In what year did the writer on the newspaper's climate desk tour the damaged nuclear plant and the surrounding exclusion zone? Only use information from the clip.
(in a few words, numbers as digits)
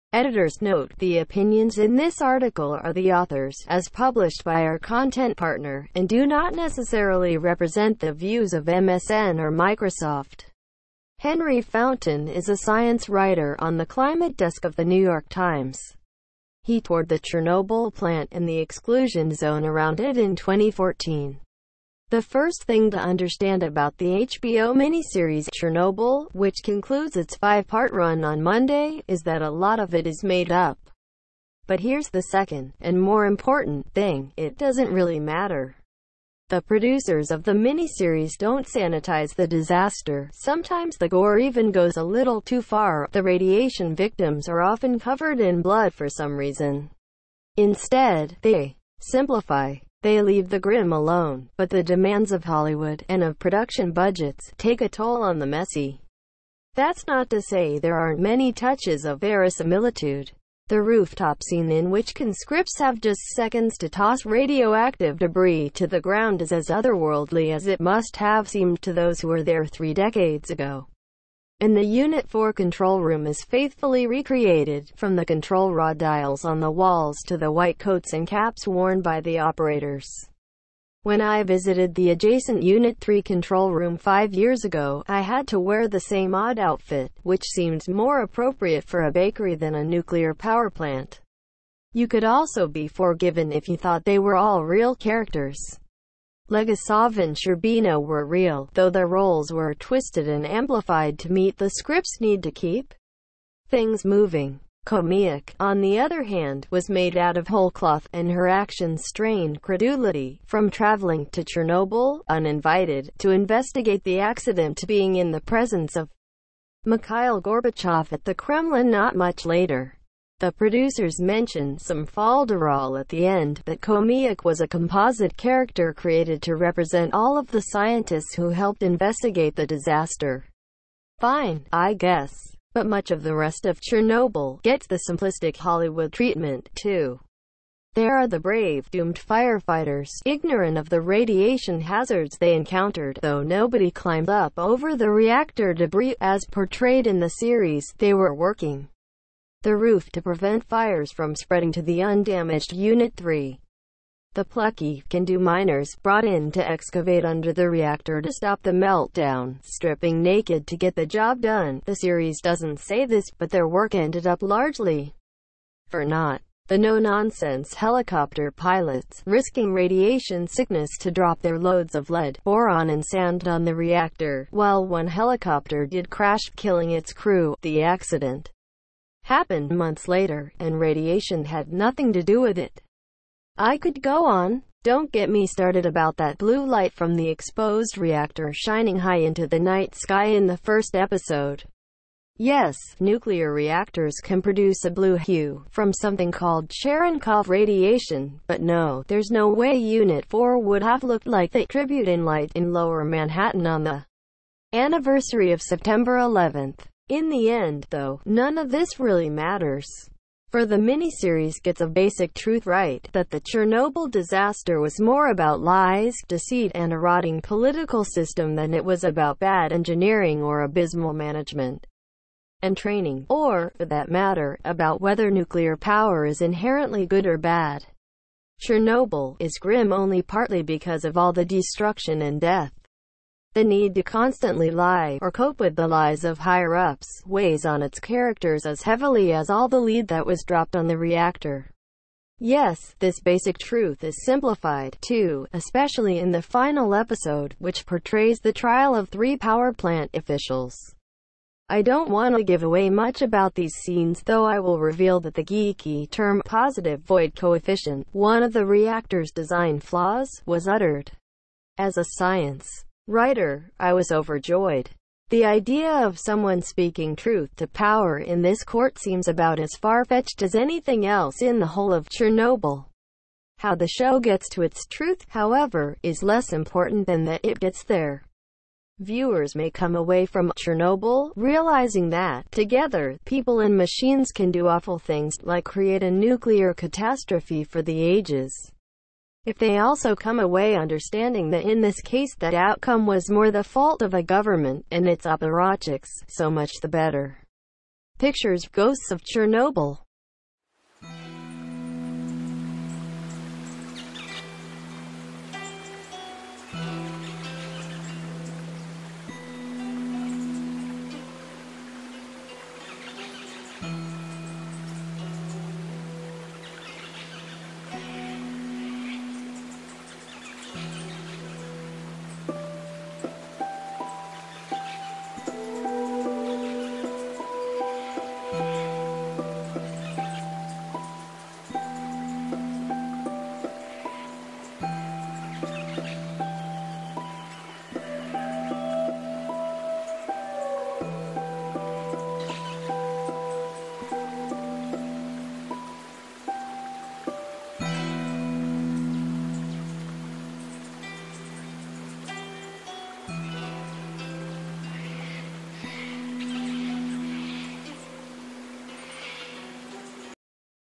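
2014.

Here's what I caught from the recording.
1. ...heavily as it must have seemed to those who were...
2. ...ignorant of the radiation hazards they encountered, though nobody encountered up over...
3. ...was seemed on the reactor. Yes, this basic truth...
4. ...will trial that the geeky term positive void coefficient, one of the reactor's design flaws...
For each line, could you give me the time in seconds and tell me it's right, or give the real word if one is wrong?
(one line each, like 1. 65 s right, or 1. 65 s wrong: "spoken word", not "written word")
1. 66 s wrong: "otherworldly", not "heavily"
2. 140 s wrong: "climbed", not "encountered"
3. 240 s wrong: "dropped", not "seemed"
4. 254 s wrong: "reveal", not "trial".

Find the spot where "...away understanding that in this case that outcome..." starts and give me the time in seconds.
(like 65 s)
290 s.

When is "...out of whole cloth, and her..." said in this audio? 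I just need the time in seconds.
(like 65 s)
107 s.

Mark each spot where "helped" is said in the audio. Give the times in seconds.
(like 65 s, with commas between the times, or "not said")
128 s.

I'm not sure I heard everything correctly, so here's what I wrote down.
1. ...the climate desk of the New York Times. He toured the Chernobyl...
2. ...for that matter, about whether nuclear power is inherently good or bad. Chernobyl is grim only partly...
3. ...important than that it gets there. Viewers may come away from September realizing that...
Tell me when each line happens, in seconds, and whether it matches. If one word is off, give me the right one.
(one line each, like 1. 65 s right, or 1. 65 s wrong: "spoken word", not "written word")
1. 13 s right
2. 223 s right
3. 276 s wrong: "Chernobyl", not "September".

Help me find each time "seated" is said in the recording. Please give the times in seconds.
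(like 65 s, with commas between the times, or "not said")
not said.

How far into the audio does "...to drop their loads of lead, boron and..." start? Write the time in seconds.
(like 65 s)
171 s.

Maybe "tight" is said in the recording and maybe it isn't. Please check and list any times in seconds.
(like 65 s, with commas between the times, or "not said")
not said.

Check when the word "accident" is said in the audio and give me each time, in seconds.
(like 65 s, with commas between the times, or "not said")
114 s, 177 s.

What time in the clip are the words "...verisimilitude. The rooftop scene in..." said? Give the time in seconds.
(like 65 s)
59 s.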